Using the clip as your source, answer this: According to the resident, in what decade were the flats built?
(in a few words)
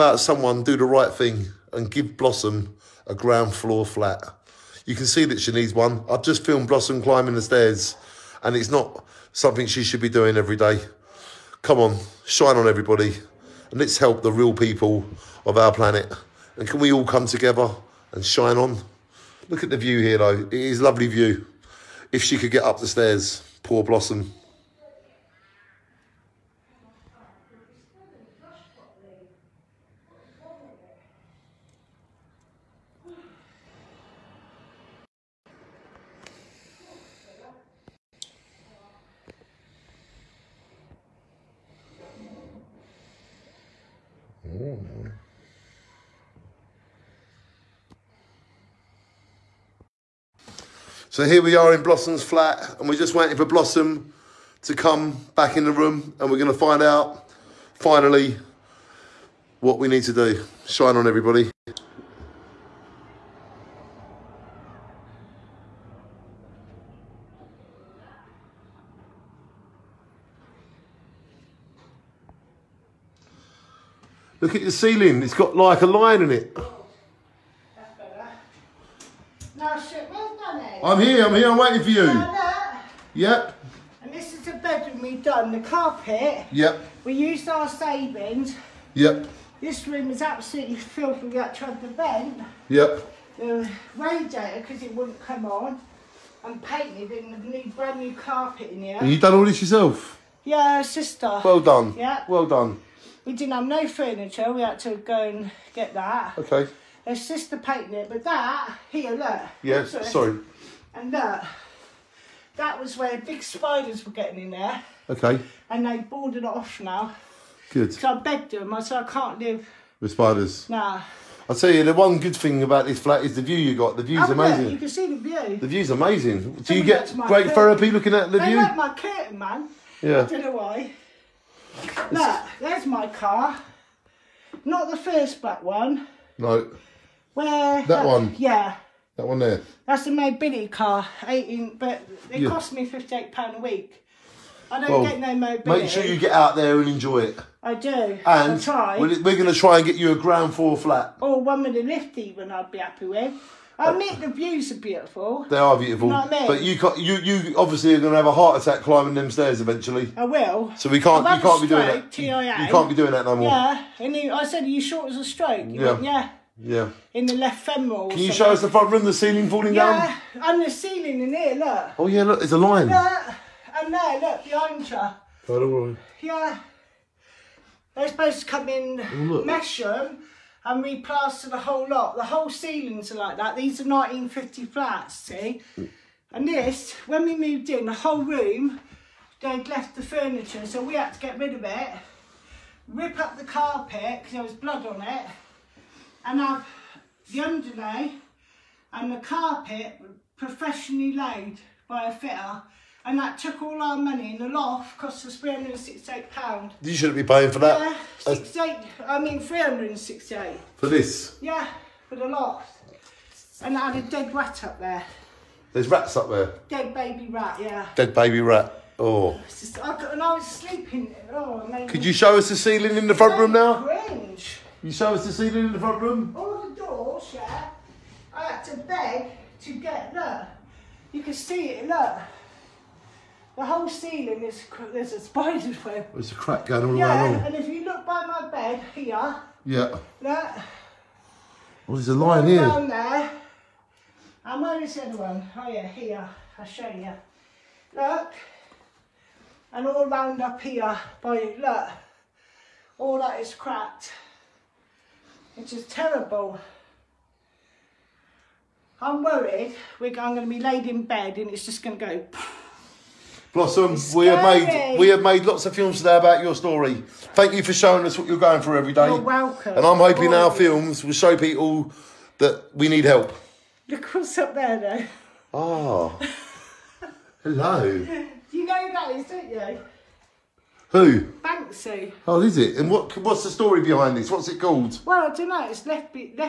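1950.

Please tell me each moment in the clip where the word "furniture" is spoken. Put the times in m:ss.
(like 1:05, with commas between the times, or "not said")
1:43, 3:10.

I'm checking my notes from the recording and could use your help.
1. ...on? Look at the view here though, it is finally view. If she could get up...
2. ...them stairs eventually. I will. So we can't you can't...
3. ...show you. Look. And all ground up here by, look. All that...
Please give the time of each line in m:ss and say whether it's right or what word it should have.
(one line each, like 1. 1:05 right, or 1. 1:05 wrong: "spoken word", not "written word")
1. 0:18 wrong: "lovely", not "finally"
2. 2:39 right
3. 4:06 wrong: "round", not "ground".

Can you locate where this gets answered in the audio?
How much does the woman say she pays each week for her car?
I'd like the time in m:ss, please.
2:22.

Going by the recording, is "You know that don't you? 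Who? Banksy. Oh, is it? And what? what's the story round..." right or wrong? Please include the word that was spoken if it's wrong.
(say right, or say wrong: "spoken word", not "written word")
wrong: "behind", not "round".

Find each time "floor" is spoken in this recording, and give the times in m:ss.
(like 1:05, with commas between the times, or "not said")
0:03, 2:30.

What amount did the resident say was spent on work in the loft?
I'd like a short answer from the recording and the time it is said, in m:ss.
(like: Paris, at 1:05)
£368, at 3:25.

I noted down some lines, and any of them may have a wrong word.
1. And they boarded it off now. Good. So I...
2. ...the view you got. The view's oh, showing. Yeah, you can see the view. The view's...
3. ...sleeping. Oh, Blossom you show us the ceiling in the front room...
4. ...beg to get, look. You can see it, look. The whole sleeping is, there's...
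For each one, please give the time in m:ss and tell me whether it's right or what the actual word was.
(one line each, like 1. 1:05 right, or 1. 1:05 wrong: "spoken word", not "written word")
1. 1:55 right
2. 2:03 wrong: "amazing", not "showing"
3. 3:40 wrong: "Could", not "Blossom"
4. 3:48 wrong: "ceiling", not "sleeping".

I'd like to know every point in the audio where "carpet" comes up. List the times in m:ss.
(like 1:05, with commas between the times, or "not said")
1:25, 1:38, 3:13, 3:19.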